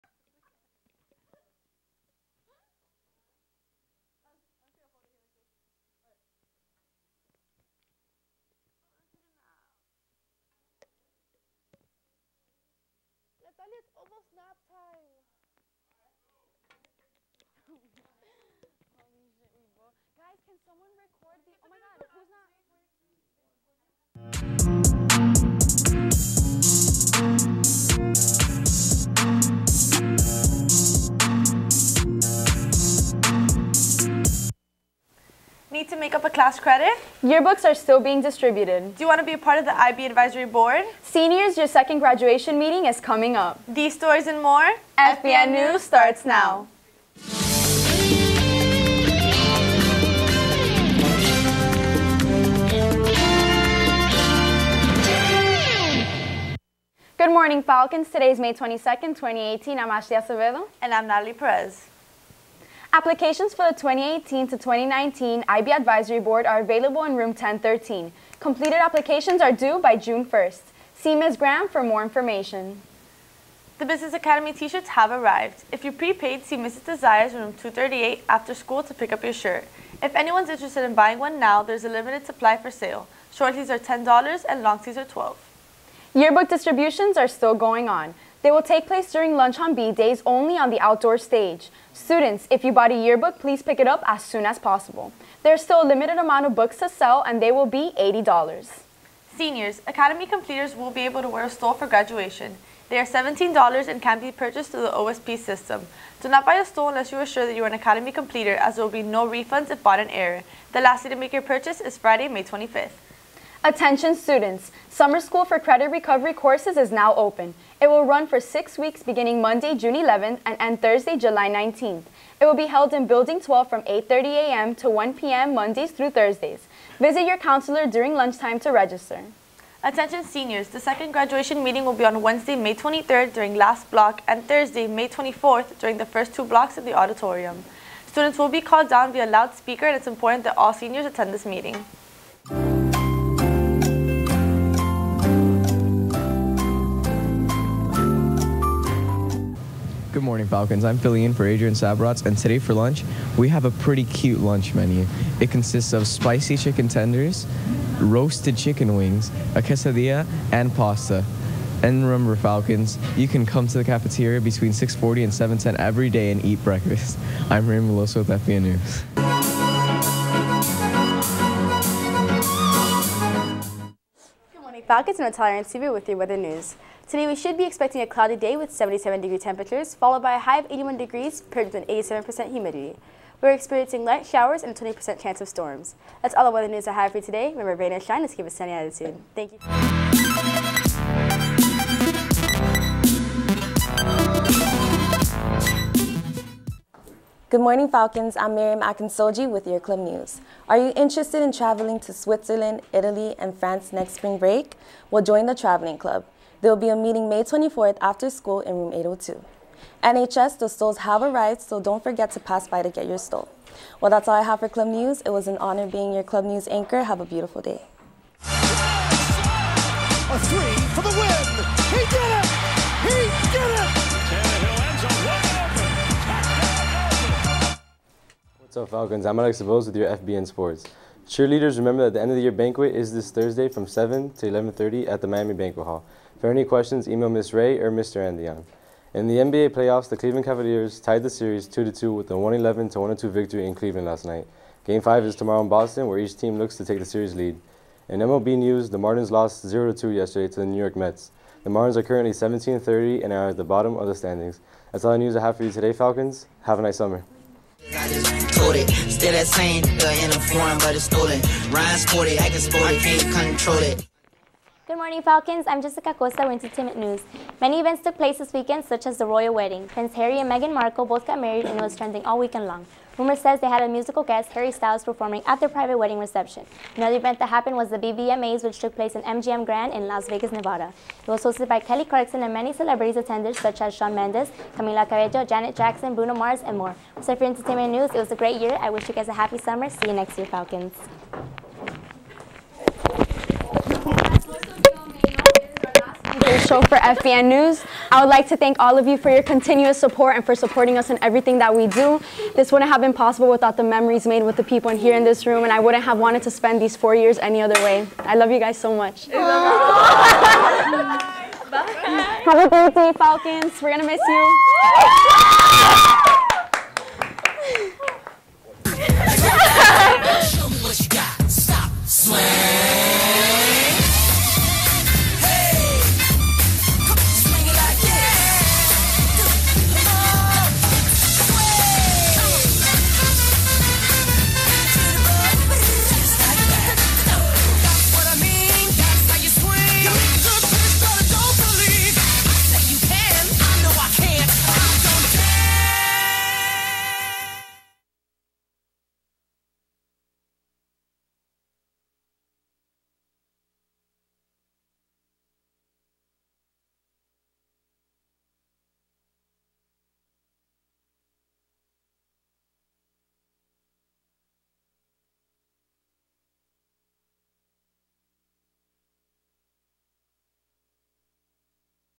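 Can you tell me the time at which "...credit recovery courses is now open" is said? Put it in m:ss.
1:55.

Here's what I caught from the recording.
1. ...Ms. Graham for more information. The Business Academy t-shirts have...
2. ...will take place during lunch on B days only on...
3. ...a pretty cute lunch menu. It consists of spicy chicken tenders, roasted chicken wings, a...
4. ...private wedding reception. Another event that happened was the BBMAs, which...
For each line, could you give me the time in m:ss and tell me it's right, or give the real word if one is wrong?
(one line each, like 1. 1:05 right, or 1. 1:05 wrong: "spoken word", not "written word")
1. 1:11 right
2. 1:28 right
3. 2:33 right
4. 4:35 right.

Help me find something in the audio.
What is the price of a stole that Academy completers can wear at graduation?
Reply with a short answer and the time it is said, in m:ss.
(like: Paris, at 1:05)
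$17, at 1:42.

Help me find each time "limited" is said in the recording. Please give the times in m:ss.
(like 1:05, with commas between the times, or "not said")
1:21, 1:35.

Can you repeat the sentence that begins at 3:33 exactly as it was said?
Well, that's all I have for club news.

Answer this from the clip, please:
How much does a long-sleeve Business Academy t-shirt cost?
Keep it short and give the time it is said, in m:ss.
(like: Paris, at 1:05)
$12, at 1:24.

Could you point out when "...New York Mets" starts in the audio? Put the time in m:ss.
4:10.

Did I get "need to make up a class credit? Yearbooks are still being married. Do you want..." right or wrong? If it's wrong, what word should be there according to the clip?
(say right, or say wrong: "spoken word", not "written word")
wrong: "distributed", not "married".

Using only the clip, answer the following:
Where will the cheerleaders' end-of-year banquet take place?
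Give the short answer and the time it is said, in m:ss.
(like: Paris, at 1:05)
Miami Banquet Hall, at 3:55.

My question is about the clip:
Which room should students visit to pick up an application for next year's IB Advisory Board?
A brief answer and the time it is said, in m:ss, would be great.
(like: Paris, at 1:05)
1013, at 1:07.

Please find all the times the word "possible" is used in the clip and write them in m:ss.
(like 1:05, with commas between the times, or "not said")
1:34, 5:03.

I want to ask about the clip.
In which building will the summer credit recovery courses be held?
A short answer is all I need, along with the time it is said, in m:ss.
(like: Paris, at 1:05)
Building 12, at 2:03.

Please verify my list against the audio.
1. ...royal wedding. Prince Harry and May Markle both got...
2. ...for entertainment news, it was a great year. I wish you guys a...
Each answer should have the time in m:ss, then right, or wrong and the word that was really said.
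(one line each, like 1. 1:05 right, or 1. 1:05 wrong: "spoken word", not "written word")
1. 4:29 wrong: "Meghan", not "May"
2. 4:47 right.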